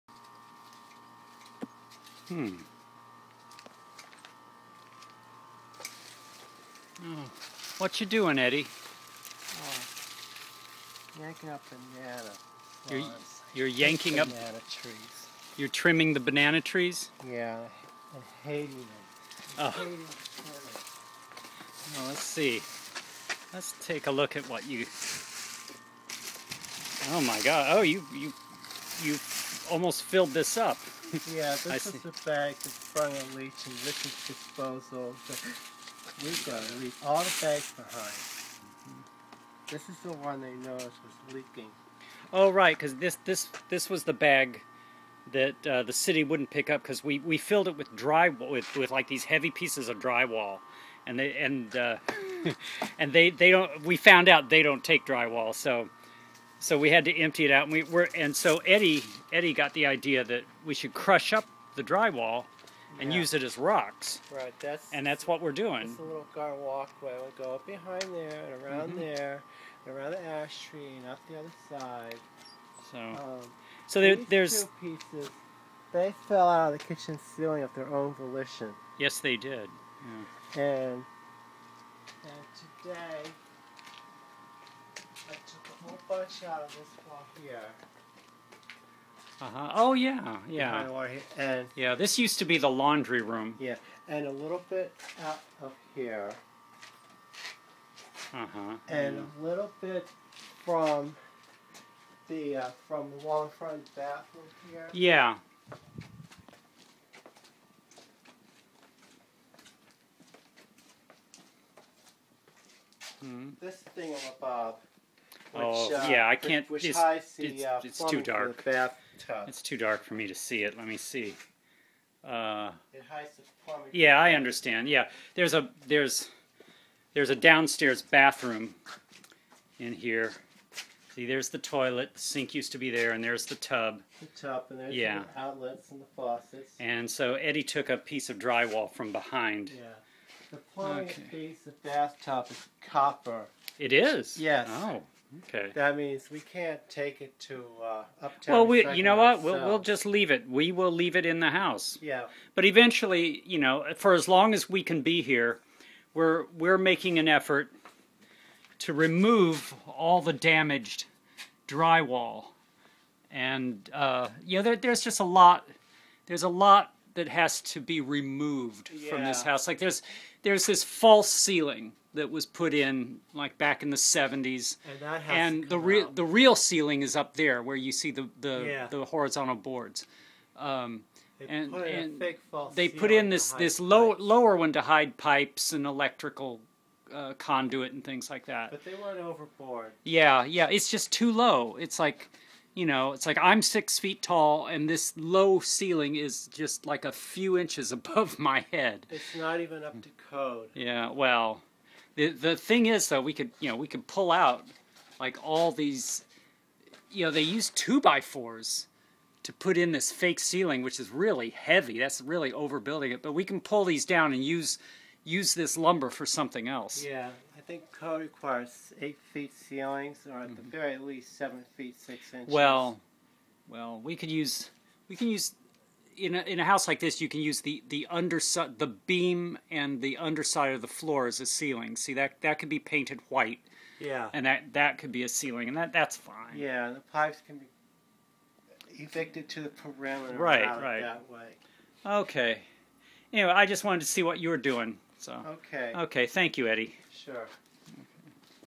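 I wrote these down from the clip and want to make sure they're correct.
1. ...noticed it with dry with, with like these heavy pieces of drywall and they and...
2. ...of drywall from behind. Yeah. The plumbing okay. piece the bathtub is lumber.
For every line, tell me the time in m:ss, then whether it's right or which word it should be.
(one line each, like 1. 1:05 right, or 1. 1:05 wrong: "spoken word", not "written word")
1. 0:47 wrong: "filled", not "noticed"
2. 2:18 wrong: "copper", not "lumber".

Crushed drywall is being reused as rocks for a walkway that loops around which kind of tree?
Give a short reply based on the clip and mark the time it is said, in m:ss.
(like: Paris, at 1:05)
Ash tree, at 1:10.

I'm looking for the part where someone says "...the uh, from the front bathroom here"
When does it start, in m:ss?
1:42.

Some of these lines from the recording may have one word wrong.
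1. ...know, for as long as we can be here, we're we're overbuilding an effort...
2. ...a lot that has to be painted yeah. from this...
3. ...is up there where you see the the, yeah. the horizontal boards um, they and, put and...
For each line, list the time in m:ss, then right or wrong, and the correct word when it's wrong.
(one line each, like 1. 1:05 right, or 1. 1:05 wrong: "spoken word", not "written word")
1. 2:33 wrong: "making", not "overbuilding"
2. 2:46 wrong: "removed", not "painted"
3. 2:57 right.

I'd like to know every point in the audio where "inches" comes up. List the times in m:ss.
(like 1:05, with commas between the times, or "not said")
3:17, 3:42.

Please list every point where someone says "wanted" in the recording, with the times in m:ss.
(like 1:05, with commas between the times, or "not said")
4:03.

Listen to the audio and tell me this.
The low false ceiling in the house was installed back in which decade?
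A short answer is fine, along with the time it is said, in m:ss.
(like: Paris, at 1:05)
The 70s, at 2:53.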